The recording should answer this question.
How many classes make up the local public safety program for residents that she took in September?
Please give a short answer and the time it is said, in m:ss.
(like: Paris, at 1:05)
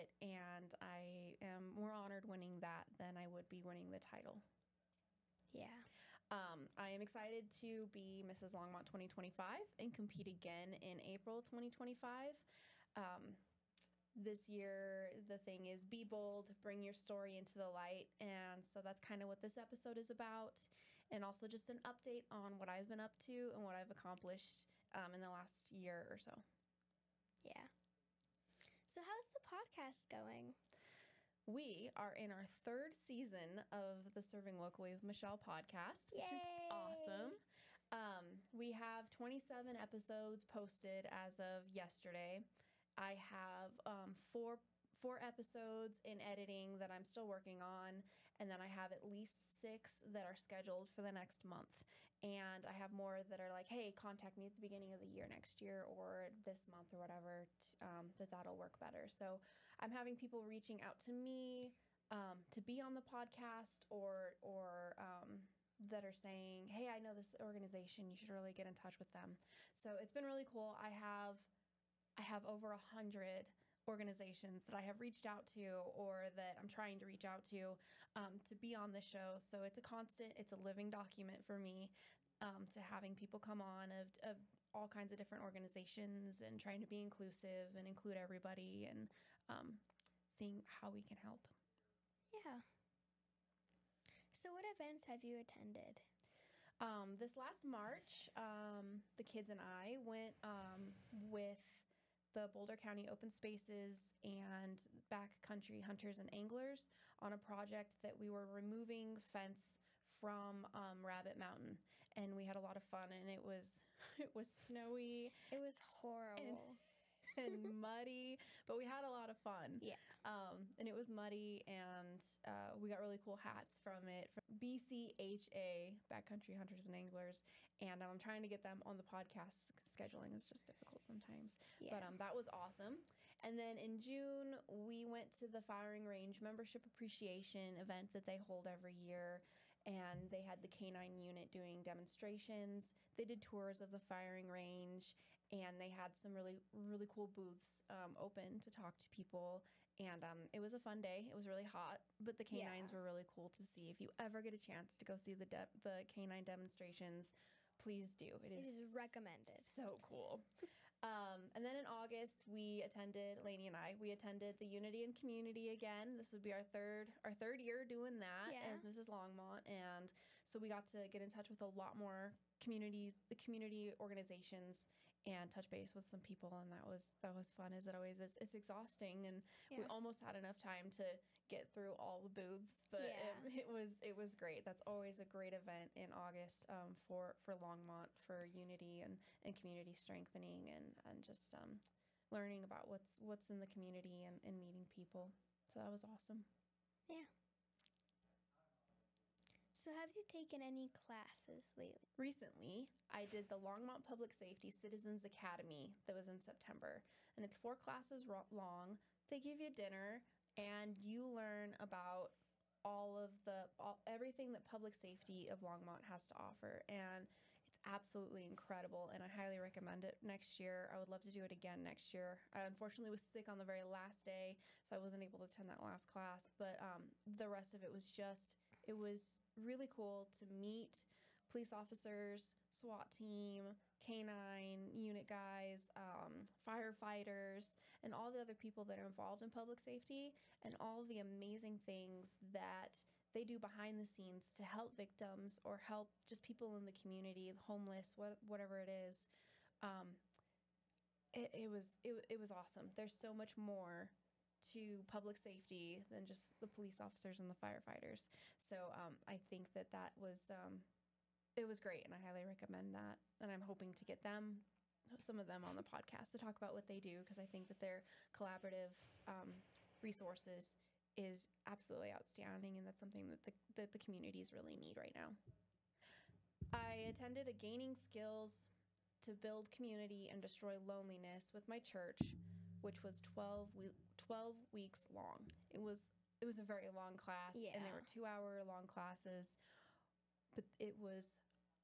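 4, at 3:27.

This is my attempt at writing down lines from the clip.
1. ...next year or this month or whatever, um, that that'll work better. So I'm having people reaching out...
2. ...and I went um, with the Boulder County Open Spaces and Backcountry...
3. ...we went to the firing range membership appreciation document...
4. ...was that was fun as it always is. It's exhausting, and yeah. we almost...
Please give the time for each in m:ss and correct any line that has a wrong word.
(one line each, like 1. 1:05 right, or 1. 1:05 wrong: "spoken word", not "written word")
1. 0:55 right
2. 1:39 right
3. 2:14 wrong: "event", not "document"
4. 2:56 right.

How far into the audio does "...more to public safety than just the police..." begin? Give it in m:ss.
4:13.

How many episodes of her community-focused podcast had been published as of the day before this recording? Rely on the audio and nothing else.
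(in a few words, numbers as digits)
27.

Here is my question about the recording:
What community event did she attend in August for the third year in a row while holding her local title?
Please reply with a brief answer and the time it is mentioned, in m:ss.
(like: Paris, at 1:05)
Unity and Community, at 2:44.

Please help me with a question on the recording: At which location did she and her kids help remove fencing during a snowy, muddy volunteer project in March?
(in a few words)
Rabbit Mountain.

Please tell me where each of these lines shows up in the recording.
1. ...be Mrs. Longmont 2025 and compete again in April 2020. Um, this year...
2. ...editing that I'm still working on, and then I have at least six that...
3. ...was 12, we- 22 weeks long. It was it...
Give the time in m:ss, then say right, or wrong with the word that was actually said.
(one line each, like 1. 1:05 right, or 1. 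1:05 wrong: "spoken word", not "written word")
1. 0:07 wrong: "2025", not "2020"
2. 0:46 right
3. 4:43 wrong: "12", not "22".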